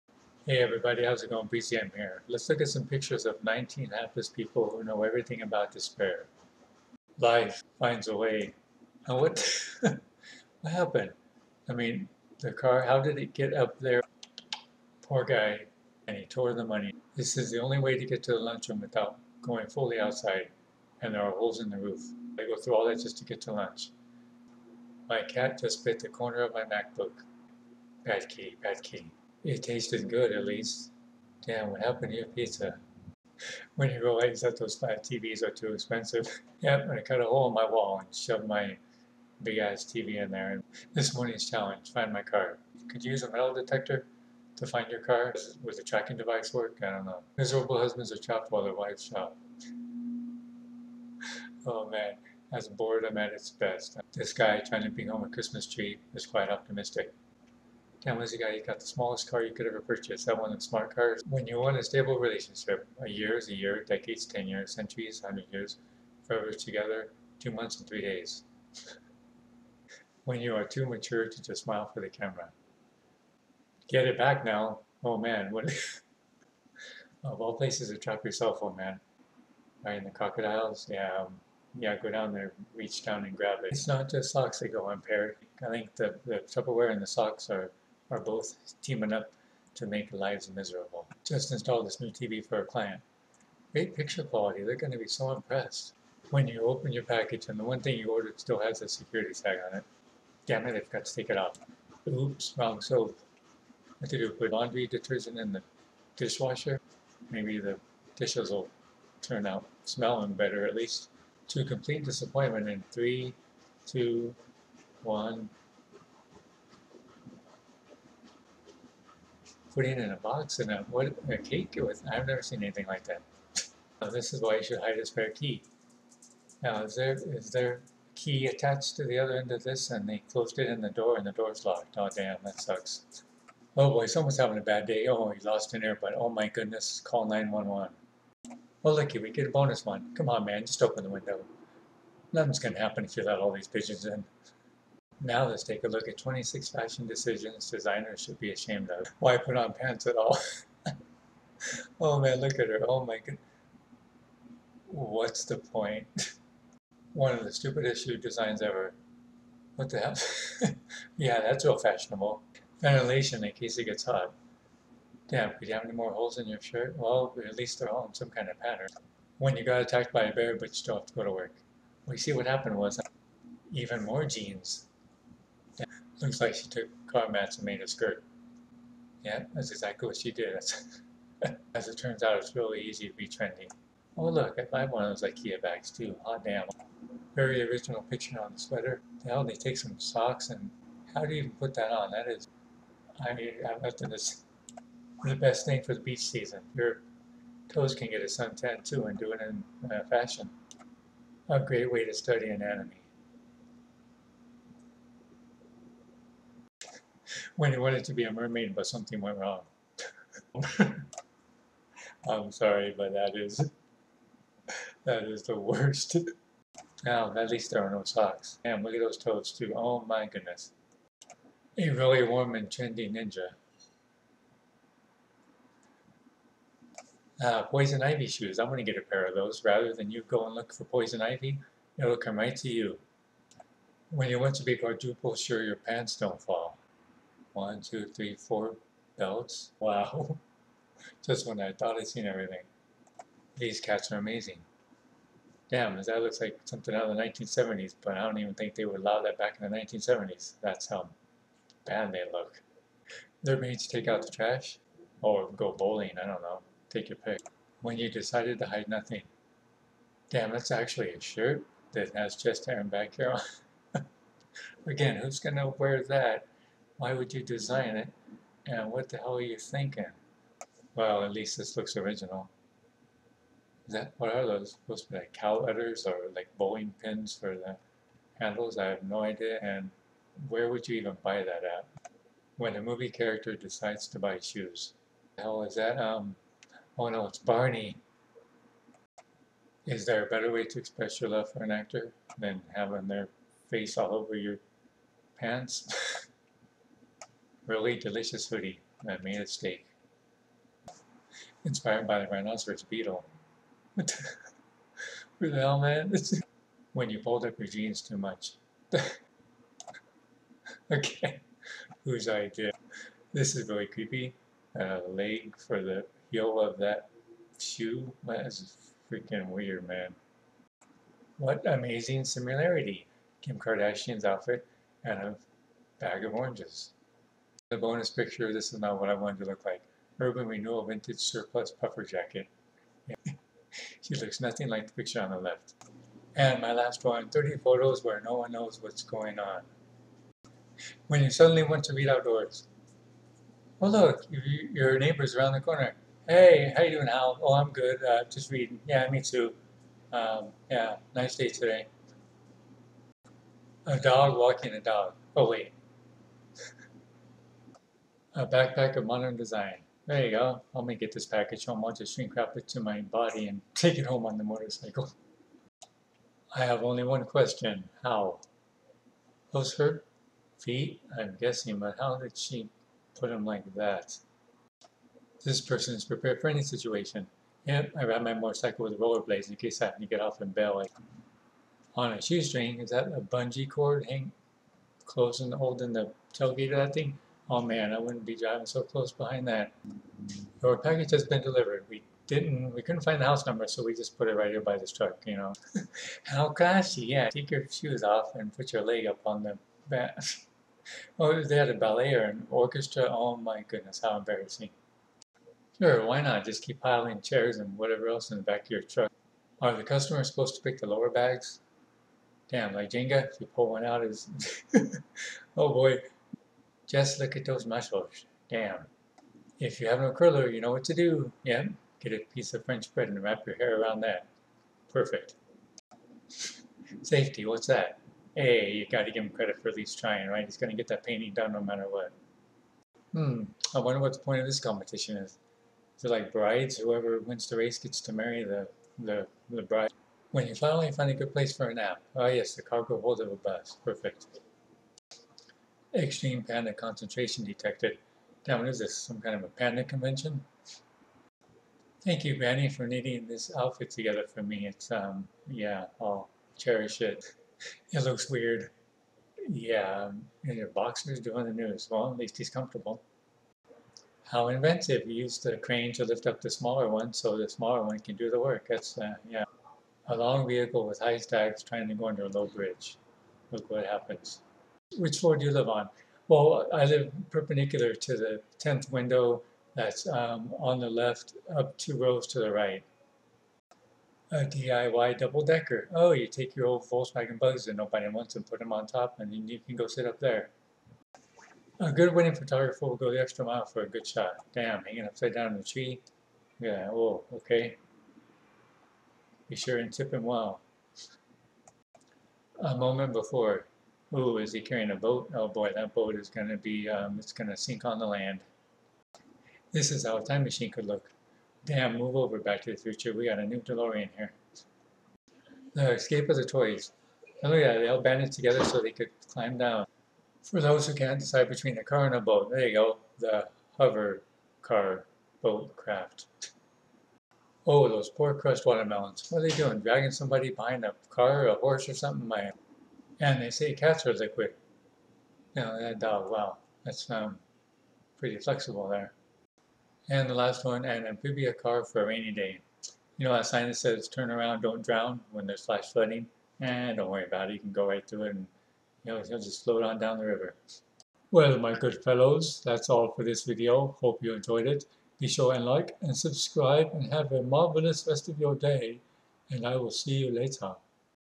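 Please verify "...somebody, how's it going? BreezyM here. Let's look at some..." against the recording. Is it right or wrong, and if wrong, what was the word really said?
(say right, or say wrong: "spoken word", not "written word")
wrong: "everybody", not "somebody".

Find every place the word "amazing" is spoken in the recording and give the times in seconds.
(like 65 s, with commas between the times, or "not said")
244 s, 321 s.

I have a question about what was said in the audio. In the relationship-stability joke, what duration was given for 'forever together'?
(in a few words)
2 months and 3 days.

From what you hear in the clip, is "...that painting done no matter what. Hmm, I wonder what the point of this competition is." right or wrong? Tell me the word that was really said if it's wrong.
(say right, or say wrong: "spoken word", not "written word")
right.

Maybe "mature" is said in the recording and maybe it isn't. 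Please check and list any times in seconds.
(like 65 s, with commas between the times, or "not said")
70 s.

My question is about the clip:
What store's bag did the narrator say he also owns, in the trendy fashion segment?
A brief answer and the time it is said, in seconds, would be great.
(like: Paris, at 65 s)
IKEA, at 185 s.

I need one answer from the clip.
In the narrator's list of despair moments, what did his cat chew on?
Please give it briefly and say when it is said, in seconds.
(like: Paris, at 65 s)
MacBook, at 26 s.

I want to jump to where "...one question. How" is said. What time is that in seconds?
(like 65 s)
367 s.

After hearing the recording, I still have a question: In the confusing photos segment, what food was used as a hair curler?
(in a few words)
French bread.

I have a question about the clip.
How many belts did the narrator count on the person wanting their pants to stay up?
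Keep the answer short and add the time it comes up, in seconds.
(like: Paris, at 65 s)
4, at 238 s.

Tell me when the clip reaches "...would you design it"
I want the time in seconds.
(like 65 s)
267 s.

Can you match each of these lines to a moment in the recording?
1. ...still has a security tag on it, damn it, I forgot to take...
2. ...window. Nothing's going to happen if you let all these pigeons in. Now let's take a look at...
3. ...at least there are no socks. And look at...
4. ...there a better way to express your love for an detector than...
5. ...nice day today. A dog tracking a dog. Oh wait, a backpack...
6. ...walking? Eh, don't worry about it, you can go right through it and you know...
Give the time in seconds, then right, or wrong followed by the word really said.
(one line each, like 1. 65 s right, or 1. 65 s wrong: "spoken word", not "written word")
1. 98 s right
2. 141 s right
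3. 217 s right
4. 290 s wrong: "actor", not "detector"
5. 351 s wrong: "walking", not "tracking"
6. 545 s wrong: "flooding", not "walking".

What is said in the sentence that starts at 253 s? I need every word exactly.
They're made to take out the trash or go bowling, I don't know.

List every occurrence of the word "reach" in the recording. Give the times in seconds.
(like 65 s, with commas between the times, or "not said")
82 s.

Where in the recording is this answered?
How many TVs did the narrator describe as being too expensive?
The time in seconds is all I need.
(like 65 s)
34 s.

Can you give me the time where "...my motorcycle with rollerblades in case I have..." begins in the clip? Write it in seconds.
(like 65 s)
378 s.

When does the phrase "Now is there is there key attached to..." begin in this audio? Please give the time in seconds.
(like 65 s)
126 s.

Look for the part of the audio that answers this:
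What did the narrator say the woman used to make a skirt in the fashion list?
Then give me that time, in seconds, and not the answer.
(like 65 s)
177 s.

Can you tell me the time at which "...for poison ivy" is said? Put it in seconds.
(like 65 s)
230 s.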